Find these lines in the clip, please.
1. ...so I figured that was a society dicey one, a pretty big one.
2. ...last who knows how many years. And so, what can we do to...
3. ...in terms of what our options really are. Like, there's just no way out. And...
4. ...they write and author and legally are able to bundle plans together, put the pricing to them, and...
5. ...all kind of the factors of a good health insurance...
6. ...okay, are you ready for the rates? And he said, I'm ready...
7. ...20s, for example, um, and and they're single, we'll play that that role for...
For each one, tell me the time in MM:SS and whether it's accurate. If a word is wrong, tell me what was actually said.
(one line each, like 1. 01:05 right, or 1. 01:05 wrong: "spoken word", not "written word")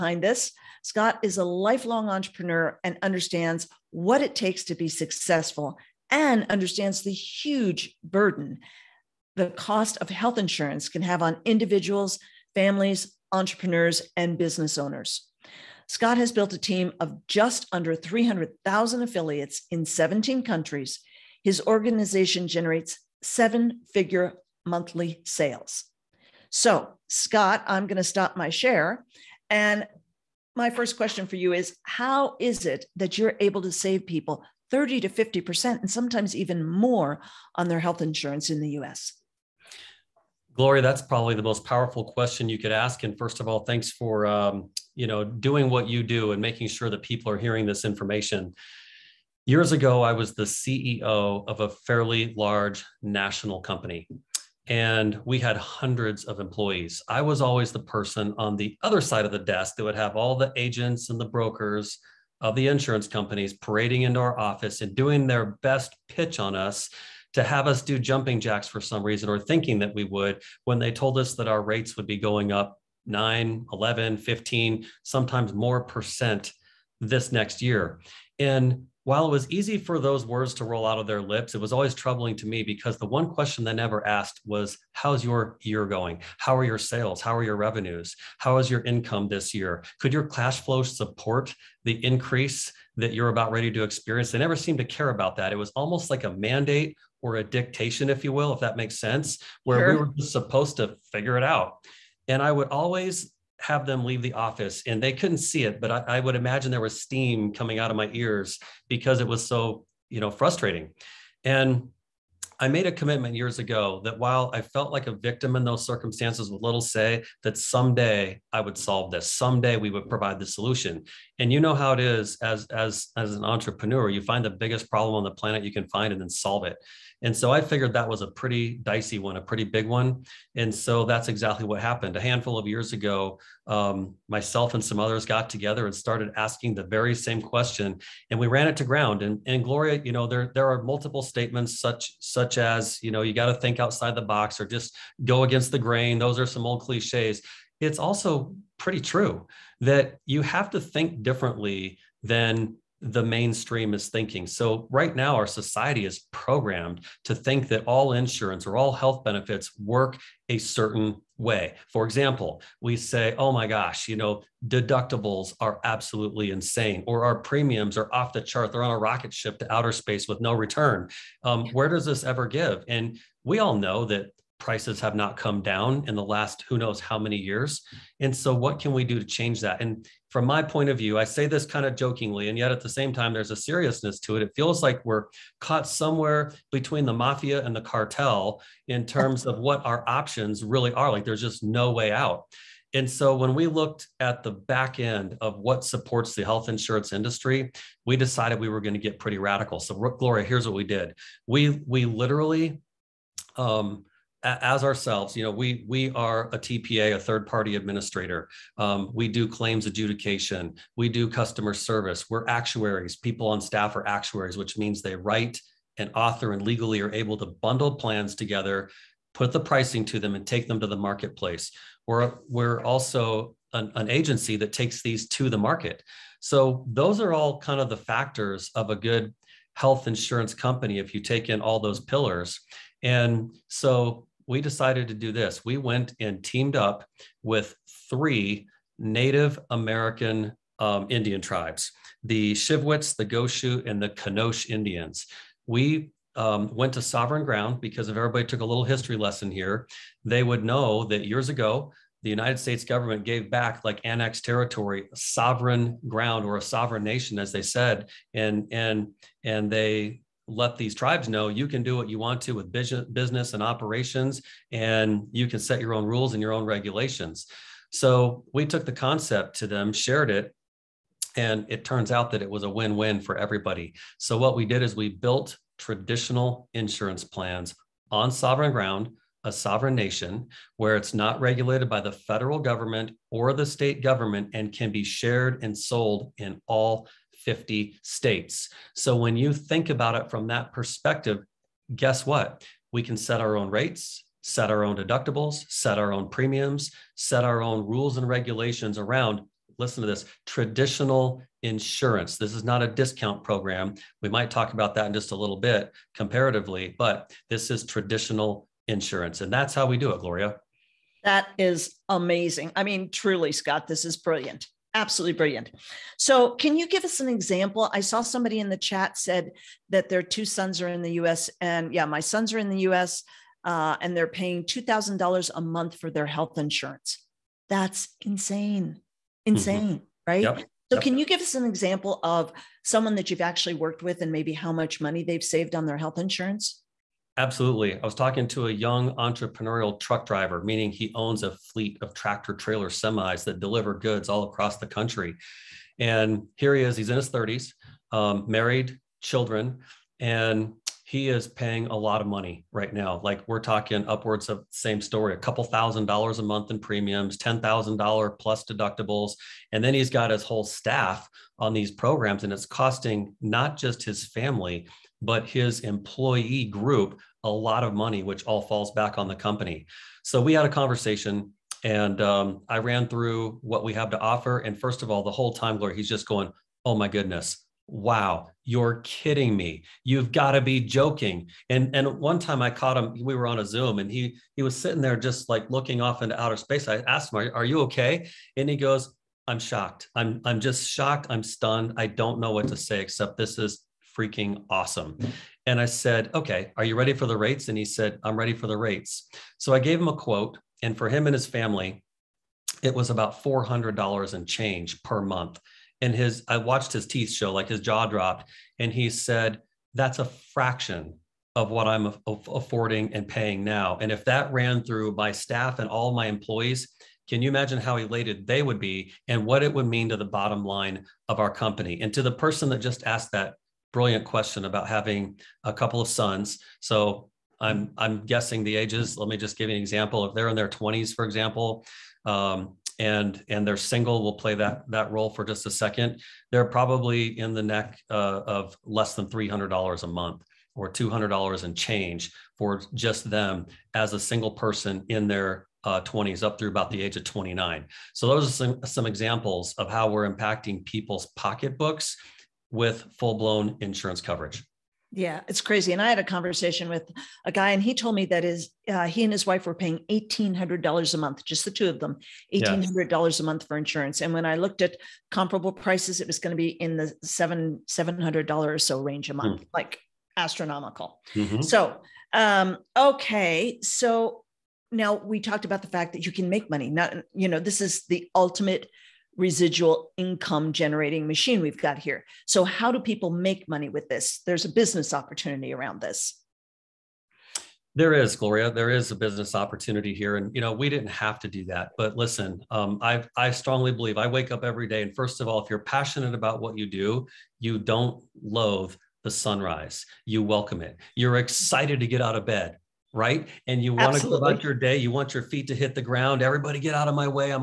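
1. 02:07 wrong: "pretty", not "society"
2. 02:56 right
3. 03:08 right
4. 03:35 right
5. 03:47 right
6. 06:36 right
7. 07:10 right.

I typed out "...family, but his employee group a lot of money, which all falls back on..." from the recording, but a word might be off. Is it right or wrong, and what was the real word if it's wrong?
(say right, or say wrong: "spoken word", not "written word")
right.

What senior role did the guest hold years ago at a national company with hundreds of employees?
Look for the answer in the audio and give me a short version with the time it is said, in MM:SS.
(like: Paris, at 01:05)
CEO, at 00:50.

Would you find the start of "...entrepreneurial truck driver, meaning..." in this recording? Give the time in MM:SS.
05:39.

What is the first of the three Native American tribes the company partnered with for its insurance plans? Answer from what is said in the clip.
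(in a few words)
Shivwits.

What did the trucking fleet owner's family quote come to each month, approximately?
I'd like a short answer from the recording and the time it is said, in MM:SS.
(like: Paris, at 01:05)
about $400, at 06:43.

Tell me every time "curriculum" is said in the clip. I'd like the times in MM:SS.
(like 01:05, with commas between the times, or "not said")
not said.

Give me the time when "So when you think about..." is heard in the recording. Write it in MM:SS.
04:48.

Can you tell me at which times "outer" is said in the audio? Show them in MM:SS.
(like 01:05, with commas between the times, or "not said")
02:49, 06:26.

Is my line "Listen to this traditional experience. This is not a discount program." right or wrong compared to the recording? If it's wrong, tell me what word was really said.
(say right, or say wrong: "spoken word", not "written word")
wrong: "insurance", not "experience".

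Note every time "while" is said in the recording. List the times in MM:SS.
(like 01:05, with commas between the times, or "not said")
01:19, 01:54.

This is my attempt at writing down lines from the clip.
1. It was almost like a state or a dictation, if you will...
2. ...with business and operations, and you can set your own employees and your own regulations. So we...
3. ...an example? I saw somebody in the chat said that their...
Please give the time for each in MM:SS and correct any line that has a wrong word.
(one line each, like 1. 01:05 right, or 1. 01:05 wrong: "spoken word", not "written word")
1. 01:35 wrong: "mandate", not "state"
2. 04:22 wrong: "rules", not "employees"
3. 05:17 right.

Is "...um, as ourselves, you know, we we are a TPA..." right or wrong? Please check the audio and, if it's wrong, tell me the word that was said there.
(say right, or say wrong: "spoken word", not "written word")
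right.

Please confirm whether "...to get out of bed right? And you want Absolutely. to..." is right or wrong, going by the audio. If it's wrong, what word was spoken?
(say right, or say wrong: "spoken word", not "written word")
right.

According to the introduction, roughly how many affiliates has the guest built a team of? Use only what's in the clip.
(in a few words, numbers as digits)
just under 300,000.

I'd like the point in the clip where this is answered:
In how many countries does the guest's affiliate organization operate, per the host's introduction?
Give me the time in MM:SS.
00:19.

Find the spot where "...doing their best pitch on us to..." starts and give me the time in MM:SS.
01:04.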